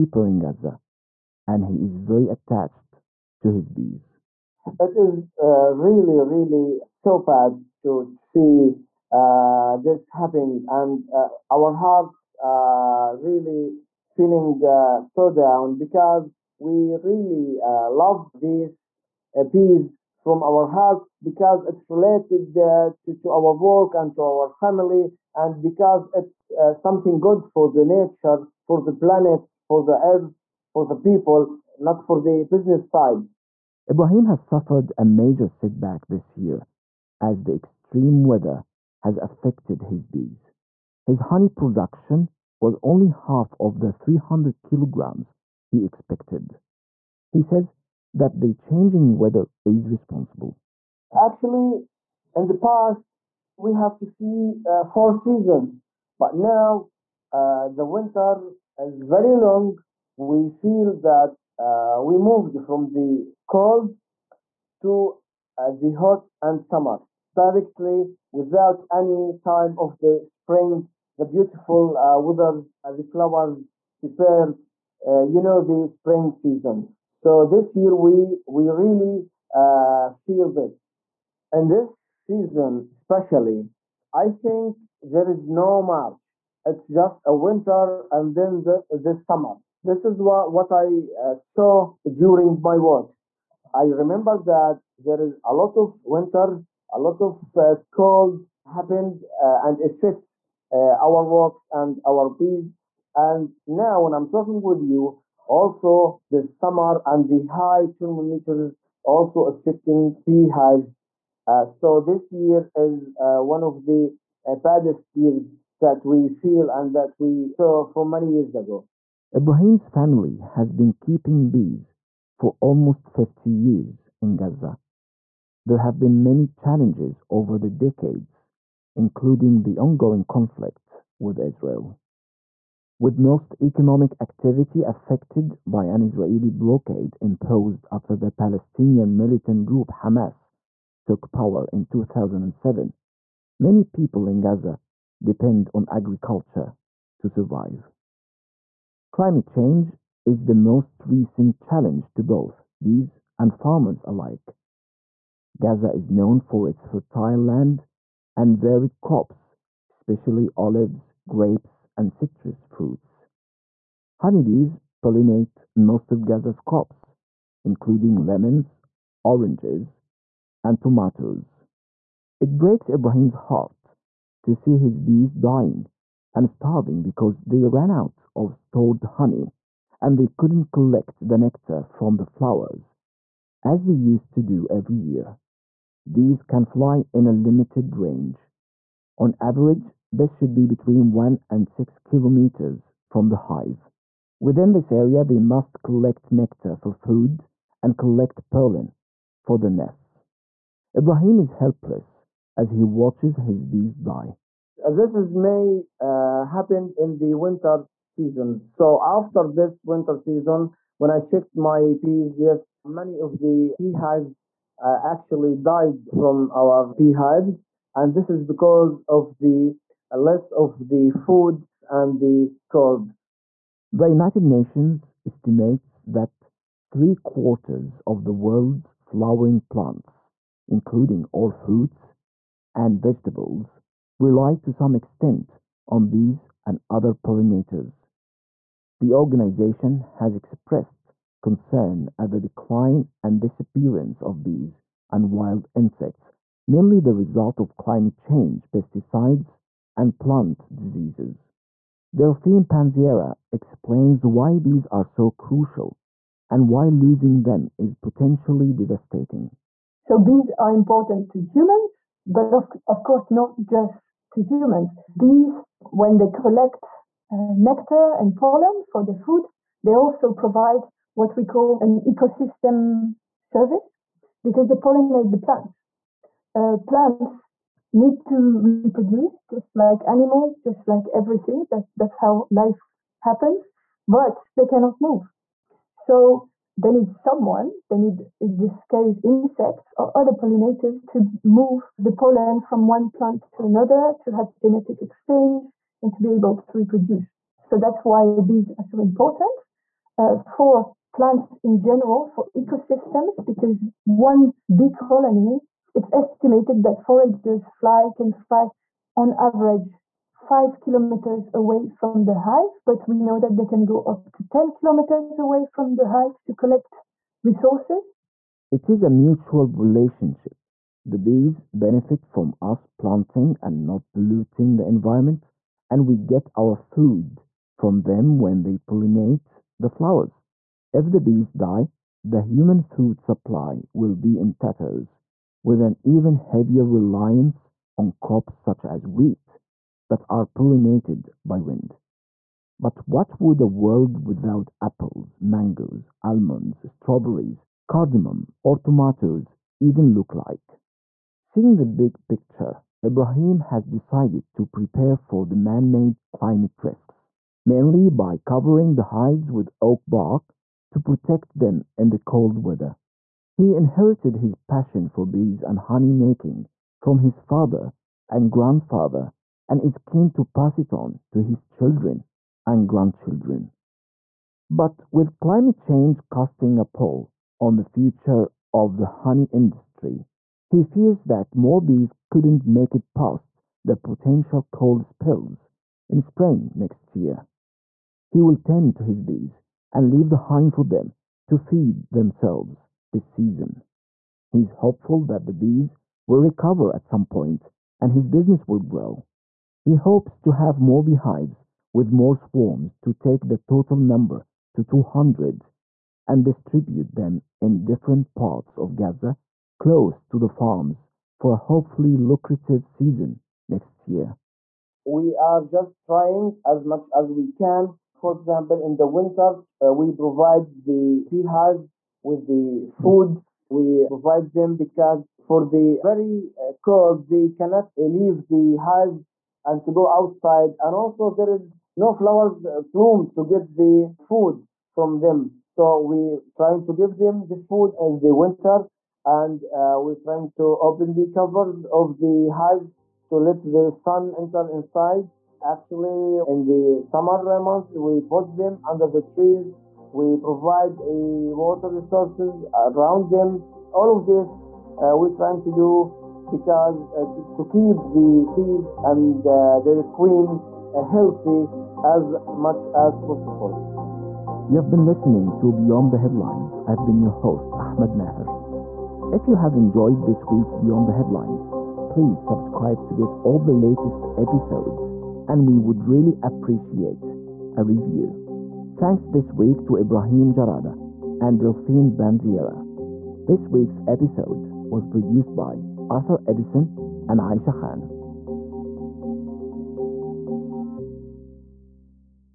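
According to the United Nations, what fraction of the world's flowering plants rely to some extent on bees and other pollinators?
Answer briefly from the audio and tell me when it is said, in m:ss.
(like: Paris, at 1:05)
three quarters, at 3:46.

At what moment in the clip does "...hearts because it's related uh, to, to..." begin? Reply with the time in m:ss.
0:20.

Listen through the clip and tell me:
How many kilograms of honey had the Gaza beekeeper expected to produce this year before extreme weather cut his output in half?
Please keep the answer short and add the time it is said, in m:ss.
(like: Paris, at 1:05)
300, at 0:43.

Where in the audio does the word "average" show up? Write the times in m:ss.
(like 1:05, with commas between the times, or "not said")
3:09, 5:09.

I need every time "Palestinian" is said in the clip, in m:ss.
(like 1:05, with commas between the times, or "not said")
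2:18.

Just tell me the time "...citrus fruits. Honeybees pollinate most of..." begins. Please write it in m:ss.
2:42.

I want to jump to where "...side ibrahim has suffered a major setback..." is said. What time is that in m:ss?
0:32.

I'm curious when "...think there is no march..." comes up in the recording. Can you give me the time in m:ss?
1:24.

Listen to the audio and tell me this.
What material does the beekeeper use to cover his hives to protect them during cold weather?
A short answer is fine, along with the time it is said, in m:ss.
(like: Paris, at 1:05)
oak bark, at 5:59.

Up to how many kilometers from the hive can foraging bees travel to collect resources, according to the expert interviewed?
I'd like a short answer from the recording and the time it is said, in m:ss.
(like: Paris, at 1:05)
10, at 5:14.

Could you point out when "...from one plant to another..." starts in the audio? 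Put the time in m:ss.
4:52.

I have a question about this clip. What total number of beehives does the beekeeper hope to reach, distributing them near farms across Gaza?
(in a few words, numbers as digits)
200.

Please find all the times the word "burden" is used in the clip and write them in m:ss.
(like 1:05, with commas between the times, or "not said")
not said.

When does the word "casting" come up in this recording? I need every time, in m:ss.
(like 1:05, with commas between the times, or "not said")
6:16.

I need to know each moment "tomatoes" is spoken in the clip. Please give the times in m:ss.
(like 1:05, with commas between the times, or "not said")
2:50, 5:48.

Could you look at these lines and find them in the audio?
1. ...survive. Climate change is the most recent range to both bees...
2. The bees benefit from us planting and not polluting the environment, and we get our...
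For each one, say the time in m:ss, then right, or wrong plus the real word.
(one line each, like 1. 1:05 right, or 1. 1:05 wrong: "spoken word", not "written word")
1. 2:27 wrong: "challenge", not "range"
2. 5:21 right.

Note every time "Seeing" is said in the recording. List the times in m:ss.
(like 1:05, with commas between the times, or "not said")
5:51.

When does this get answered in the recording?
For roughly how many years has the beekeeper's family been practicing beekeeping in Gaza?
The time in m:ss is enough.
2:03.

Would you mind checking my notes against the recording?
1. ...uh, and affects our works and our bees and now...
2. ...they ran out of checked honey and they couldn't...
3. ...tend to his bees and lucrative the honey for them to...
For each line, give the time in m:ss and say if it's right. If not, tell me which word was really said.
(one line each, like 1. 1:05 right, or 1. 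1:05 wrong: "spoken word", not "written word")
1. 1:39 right
2. 2:57 wrong: "stored", not "checked"
3. 6:28 wrong: "leave", not "lucrative".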